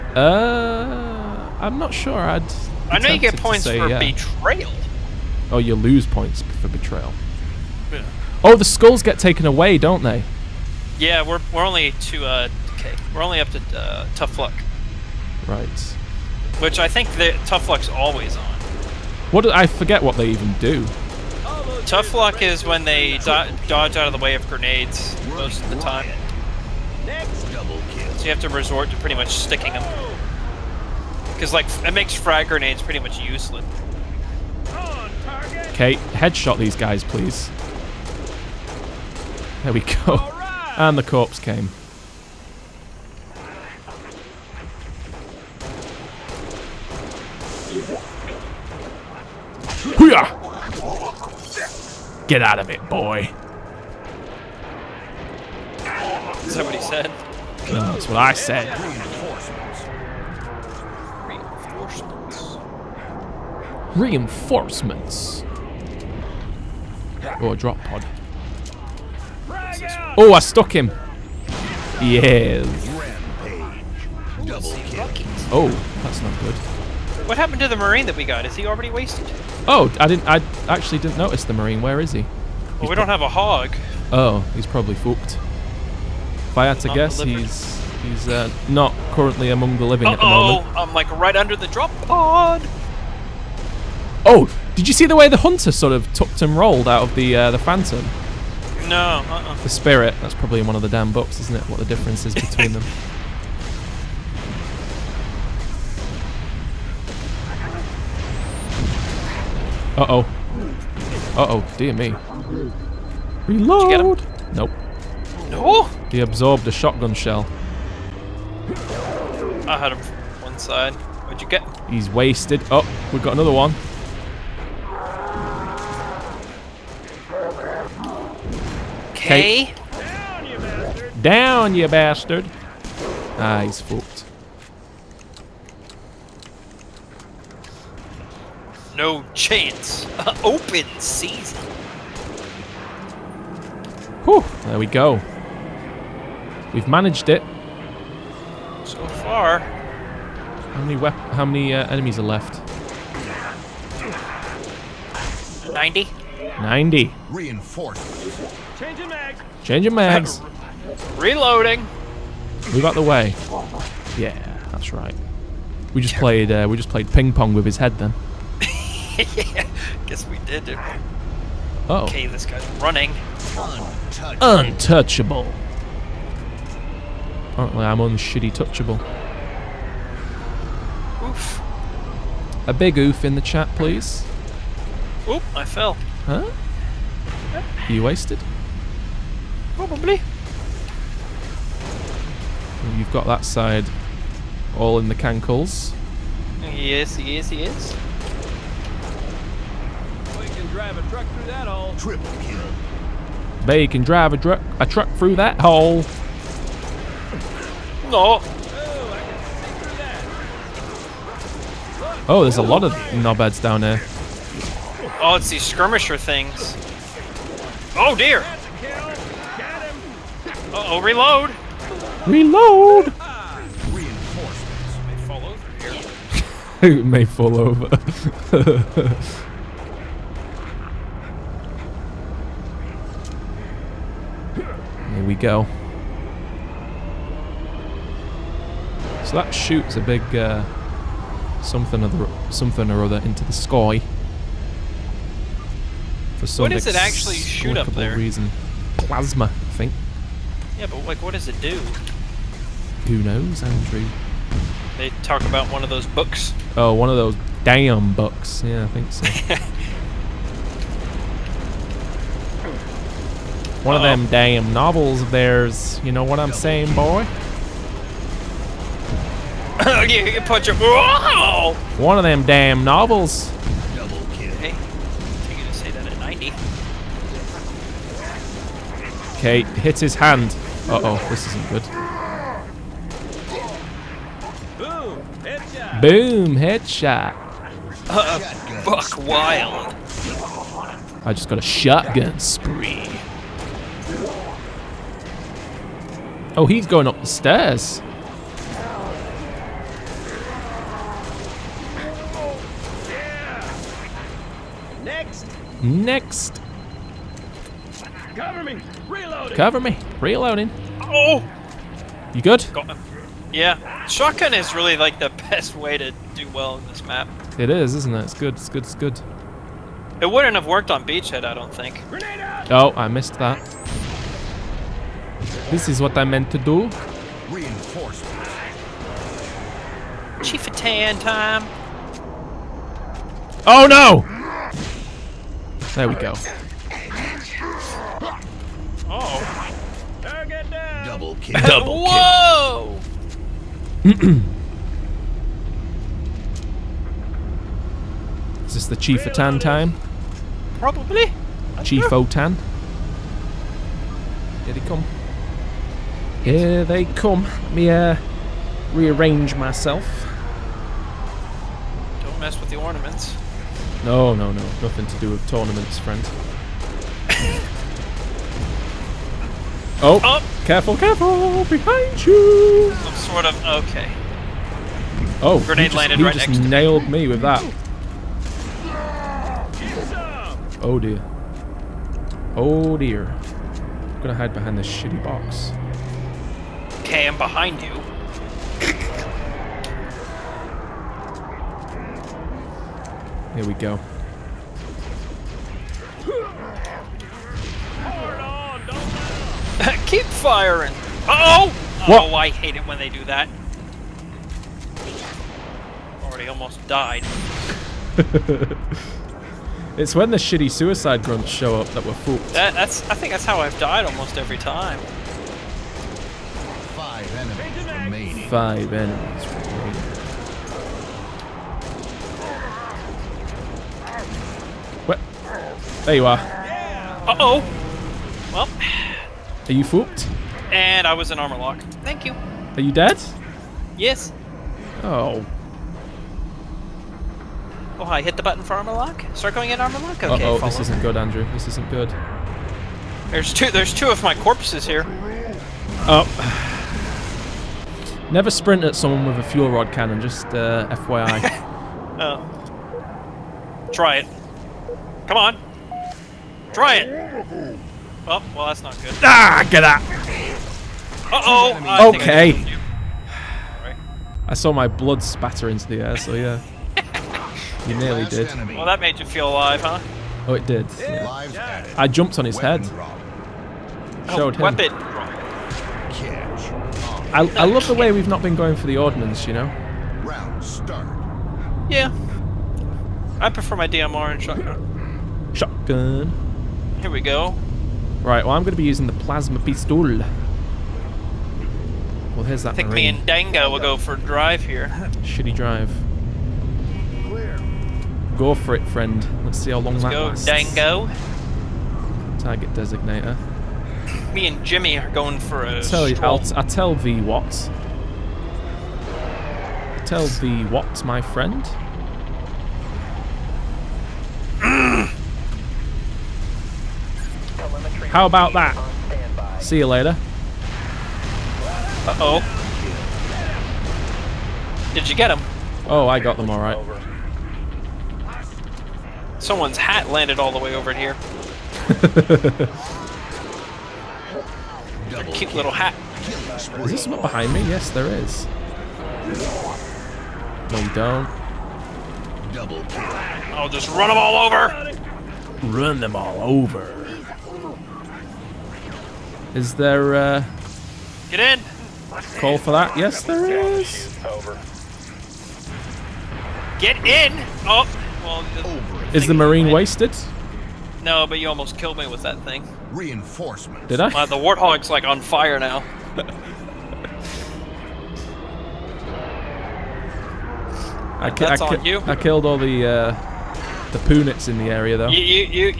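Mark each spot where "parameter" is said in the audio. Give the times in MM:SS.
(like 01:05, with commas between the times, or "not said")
not said.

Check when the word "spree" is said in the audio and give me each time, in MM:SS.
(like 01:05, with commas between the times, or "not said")
04:52.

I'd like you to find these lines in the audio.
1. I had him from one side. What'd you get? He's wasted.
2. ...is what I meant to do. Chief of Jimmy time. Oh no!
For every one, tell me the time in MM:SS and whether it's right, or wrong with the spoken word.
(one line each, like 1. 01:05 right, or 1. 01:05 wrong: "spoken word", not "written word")
1. 01:59 right
2. 05:25 wrong: "Tan", not "Jimmy".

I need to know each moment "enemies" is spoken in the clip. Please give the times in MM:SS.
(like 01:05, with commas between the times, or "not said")
02:31, 06:58.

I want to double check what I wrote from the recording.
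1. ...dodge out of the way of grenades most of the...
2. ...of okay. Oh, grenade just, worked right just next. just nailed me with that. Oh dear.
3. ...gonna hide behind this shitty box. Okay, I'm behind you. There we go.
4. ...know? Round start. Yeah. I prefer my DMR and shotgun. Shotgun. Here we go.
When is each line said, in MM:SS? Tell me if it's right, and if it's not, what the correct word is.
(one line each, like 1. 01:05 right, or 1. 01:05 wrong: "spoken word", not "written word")
1. 00:23 right
2. 06:13 wrong: "landed", not "worked"
3. 06:24 right
4. 07:59 right.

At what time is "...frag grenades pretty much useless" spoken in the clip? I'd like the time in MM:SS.
00:32.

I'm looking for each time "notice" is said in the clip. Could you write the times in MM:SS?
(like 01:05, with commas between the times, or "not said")
01:21.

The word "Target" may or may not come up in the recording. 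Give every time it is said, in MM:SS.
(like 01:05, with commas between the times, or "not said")
05:40, 08:22.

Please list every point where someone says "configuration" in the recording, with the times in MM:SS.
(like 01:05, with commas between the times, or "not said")
not said.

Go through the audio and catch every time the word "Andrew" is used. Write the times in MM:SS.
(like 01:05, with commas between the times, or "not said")
04:13, 07:21.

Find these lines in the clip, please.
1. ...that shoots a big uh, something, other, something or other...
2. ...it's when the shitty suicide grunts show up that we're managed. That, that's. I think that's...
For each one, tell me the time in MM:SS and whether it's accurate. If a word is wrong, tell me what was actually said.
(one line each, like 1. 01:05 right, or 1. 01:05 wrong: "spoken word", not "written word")
1. 03:59 right
2. 06:49 wrong: "fooled", not "managed".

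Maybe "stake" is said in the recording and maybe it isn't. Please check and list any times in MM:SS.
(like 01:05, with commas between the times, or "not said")
not said.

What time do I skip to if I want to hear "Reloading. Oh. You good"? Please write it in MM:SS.
05:10.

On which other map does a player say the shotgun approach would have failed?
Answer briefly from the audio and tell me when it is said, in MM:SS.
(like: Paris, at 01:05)
Beachhead, at 05:21.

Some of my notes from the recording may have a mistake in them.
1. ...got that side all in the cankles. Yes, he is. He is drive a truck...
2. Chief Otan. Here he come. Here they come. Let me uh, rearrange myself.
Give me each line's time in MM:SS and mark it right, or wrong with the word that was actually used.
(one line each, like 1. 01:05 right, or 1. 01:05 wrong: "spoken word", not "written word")
1. 03:13 right
2. 05:51 right.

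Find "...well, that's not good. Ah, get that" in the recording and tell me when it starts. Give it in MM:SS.
07:38.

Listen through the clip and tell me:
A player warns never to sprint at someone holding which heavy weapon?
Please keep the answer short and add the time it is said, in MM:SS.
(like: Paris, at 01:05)
Fuel rod cannon, at 07:29.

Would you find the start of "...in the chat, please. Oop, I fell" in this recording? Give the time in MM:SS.
03:03.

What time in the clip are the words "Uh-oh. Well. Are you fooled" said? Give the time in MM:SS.
07:06.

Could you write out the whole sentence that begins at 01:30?
Oh, I'm like right under the drop pod.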